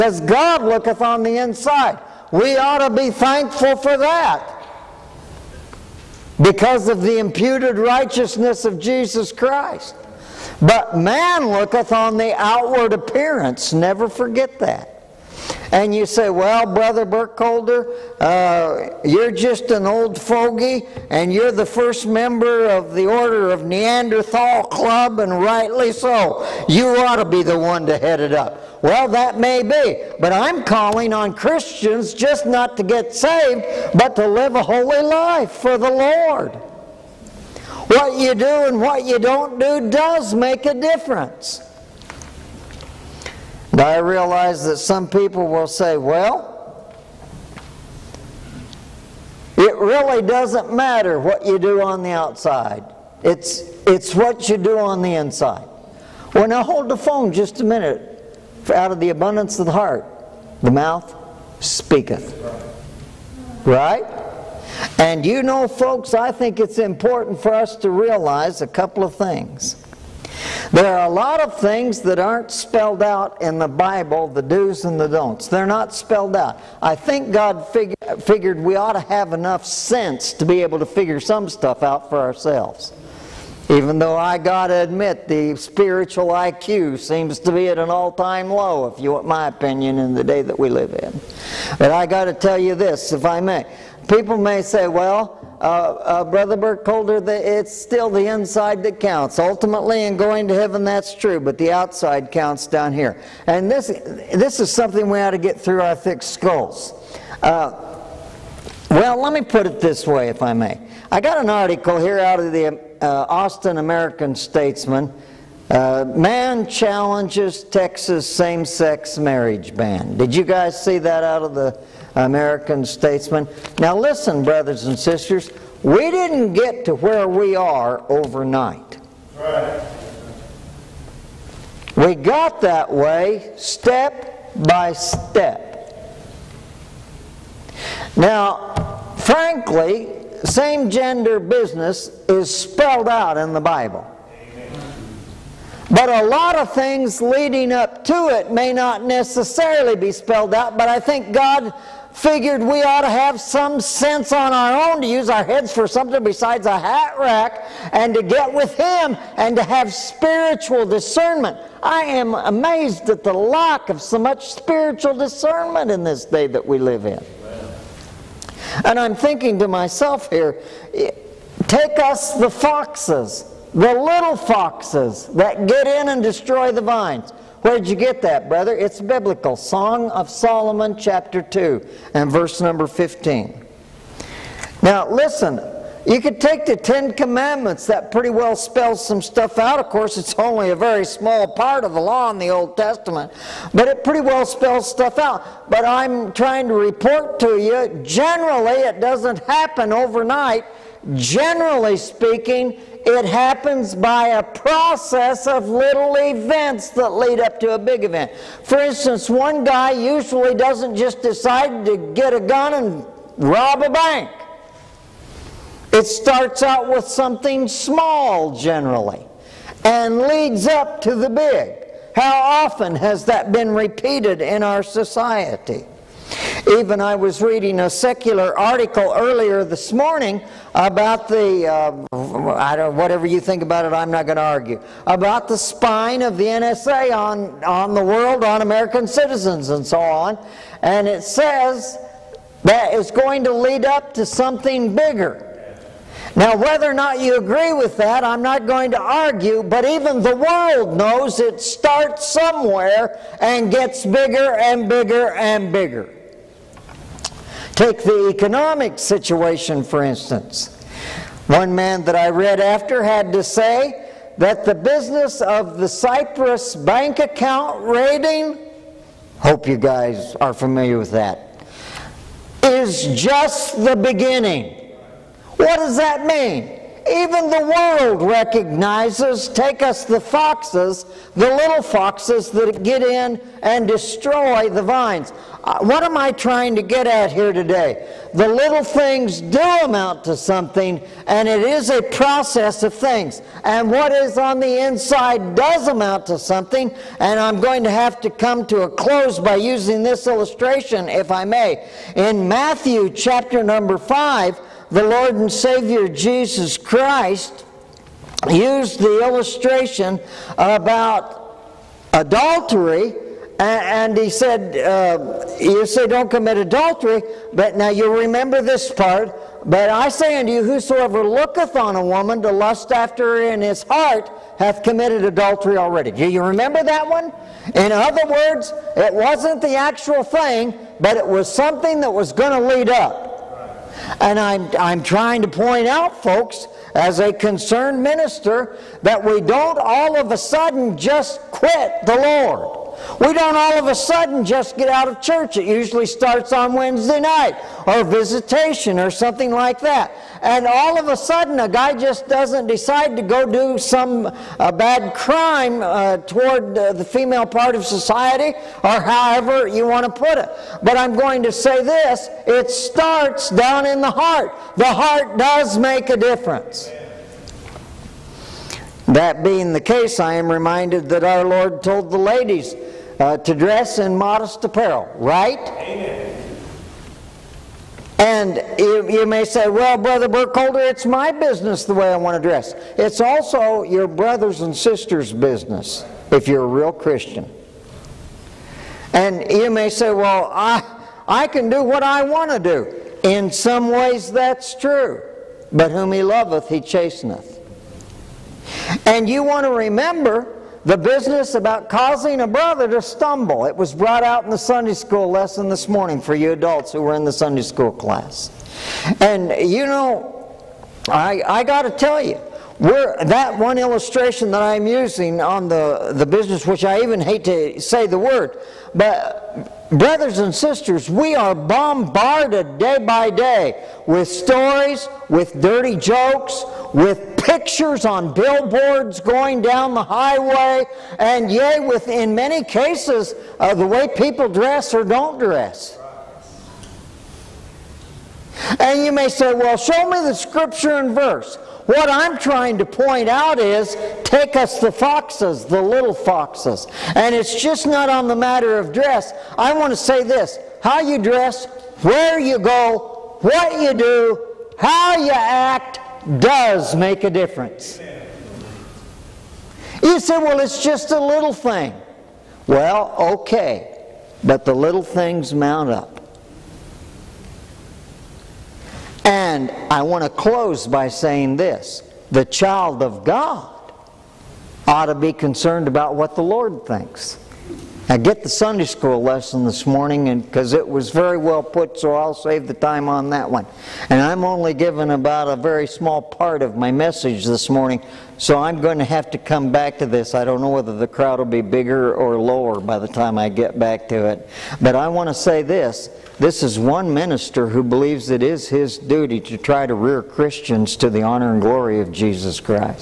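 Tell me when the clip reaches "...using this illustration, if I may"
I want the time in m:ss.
4:59.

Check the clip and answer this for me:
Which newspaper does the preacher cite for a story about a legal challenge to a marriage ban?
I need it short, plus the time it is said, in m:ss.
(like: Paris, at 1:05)
Austin American Statesman, at 1:53.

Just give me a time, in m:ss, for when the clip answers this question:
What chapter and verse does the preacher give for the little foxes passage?
3:00.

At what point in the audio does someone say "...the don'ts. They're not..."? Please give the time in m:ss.
1:14.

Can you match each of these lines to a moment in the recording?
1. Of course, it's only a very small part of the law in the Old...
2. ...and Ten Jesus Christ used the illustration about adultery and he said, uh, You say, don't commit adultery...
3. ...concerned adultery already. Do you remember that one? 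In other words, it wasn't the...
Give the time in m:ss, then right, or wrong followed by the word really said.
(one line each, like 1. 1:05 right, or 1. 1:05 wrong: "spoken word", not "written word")
1. 3:09 right
2. 5:05 wrong: "Savior", not "Ten"
3. 5:24 wrong: "committed", not "concerned".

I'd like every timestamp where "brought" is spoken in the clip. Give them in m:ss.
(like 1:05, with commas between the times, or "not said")
6:43.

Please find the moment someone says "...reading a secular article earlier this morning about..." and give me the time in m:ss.
3:47.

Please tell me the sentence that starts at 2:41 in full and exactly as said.
I am amazed at the lack of so much spiritual discernment in this day that we live in.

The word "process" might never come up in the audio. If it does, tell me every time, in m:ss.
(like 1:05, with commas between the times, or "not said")
3:24, 4:52.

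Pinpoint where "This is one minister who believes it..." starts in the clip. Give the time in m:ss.
8:16.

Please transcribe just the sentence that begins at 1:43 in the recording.
And this, this is something we ought to get through our thick skulls.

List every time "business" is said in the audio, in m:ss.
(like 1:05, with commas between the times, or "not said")
2:21, 4:24, 6:21, 6:25, 6:40, 6:56.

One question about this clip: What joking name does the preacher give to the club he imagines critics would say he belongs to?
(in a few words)
Order of Neanderthal Club.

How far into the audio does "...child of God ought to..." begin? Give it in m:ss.
7:52.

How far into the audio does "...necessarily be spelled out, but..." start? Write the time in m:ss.
2:29.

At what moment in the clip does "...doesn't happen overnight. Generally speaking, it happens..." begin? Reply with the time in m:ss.
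3:19.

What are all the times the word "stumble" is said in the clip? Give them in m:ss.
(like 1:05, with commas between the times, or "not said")
6:43.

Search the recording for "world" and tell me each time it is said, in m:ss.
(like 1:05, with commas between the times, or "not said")
3:58, 4:10, 4:37.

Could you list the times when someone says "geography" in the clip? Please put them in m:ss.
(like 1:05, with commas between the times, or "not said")
not said.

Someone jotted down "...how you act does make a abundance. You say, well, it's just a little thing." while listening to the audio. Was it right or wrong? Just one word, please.
wrong.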